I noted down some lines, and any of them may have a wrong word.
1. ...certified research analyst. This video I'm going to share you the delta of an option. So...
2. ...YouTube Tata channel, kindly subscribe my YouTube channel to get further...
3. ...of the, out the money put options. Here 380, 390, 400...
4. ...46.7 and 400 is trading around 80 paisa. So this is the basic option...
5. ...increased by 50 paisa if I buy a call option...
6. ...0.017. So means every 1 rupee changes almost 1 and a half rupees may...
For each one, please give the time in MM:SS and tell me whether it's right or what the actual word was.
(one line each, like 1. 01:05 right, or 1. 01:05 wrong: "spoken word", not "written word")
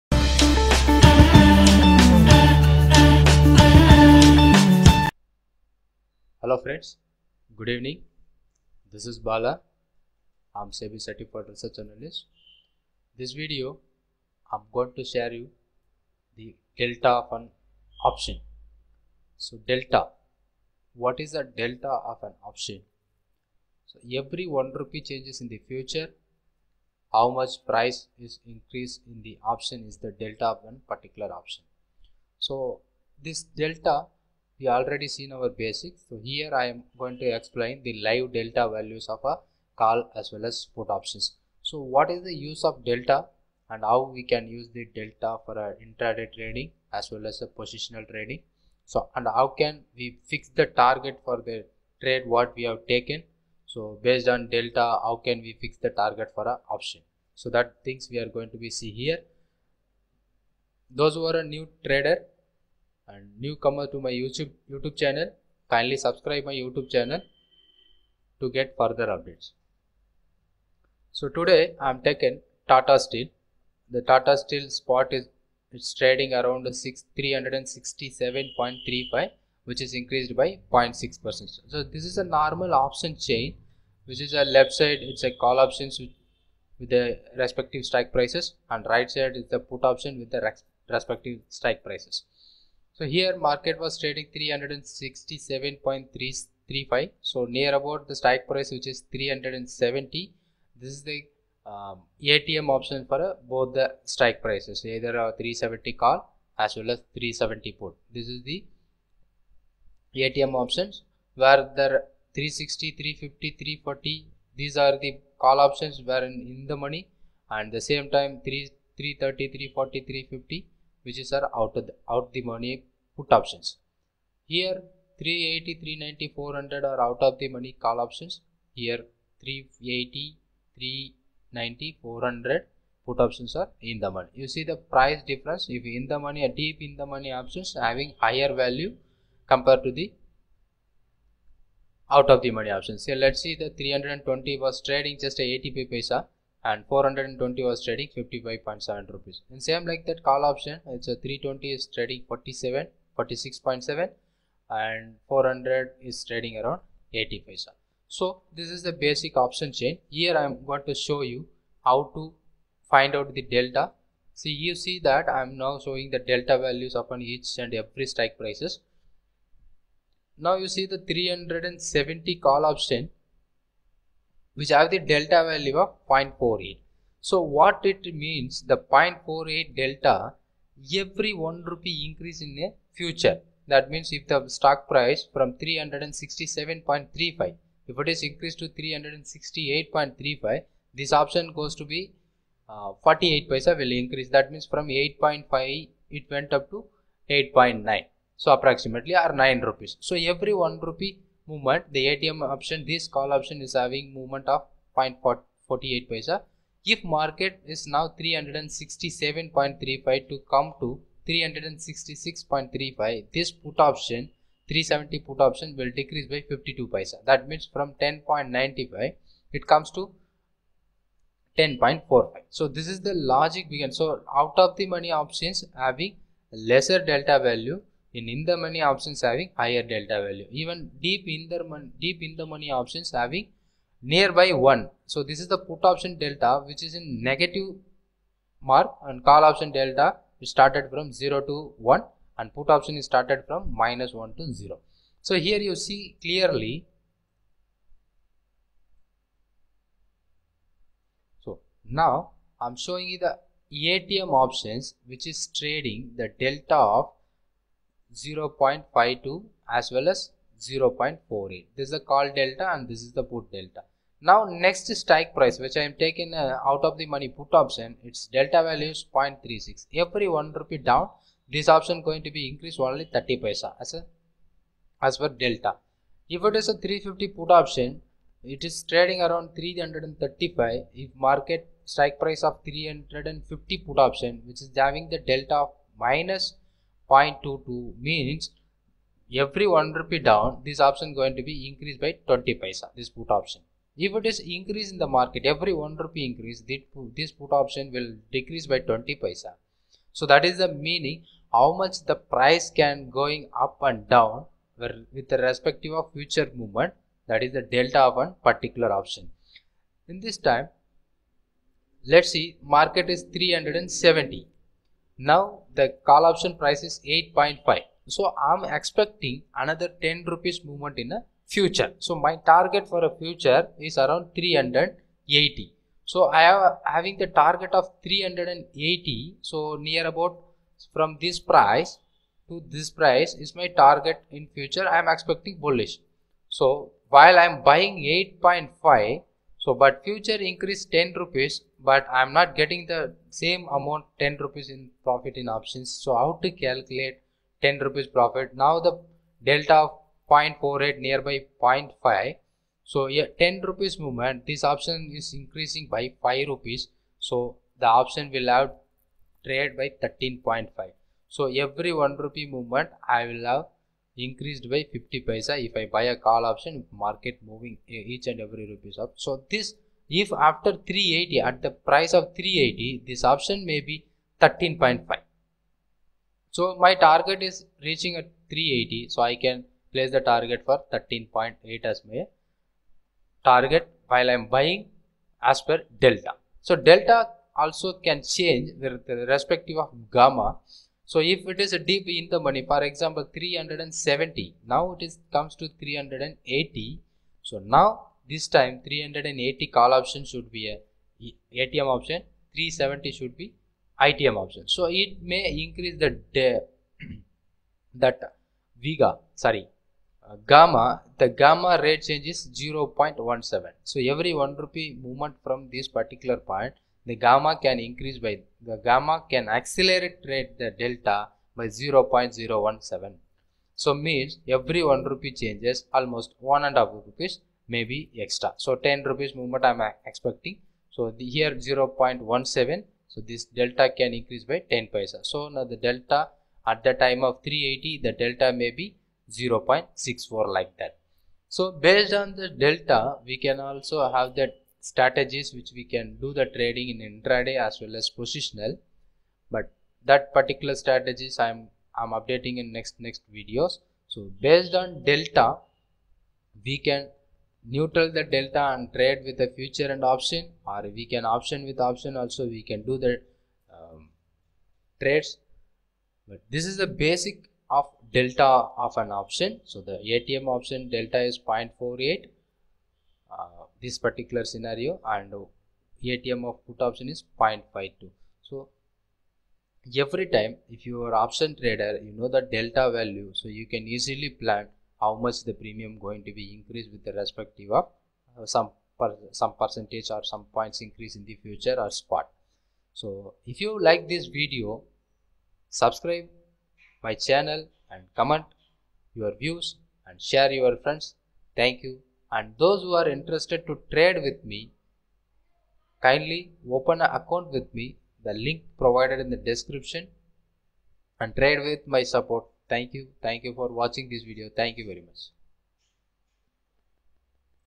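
1. 00:11 right
2. 01:04 wrong: "YouTube", not "Tata"
3. 02:01 right
4. 02:33 right
5. 06:04 right
6. 07:01 right.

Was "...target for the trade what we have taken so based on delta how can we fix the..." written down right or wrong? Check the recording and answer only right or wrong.
right.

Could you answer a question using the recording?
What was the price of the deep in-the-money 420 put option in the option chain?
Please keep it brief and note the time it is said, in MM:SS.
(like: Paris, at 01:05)
55.7 rupees, at 02:28.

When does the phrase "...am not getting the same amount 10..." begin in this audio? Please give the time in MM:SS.
05:42.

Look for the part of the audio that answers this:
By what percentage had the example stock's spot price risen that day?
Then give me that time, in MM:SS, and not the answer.
01:20.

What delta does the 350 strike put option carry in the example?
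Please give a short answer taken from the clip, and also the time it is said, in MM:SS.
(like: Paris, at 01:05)
-0.22, at 04:46.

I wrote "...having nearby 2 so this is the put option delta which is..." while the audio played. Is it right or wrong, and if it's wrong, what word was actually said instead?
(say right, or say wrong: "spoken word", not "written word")
wrong: "1", not "2".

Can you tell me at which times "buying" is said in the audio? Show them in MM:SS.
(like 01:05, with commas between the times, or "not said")
05:37, 06:24.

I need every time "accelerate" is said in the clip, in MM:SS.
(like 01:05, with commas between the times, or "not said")
06:59.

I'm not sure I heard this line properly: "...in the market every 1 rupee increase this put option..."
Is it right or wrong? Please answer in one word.
right.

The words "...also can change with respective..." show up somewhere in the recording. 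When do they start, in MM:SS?
06:27.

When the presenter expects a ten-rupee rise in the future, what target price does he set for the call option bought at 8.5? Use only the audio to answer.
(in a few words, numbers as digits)
13.8.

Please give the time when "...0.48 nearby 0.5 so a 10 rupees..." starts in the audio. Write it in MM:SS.
05:50.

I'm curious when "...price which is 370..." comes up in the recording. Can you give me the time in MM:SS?
01:38.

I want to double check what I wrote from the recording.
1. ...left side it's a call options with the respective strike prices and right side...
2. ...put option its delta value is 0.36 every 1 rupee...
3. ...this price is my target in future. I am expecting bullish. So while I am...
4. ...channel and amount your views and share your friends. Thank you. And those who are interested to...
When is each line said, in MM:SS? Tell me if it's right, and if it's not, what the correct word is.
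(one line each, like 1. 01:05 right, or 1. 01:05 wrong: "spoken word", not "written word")
1. 01:24 right
2. 04:27 right
3. 05:32 right
4. 08:17 wrong: "comment", not "amount".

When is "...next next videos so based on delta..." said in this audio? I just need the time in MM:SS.
07:32.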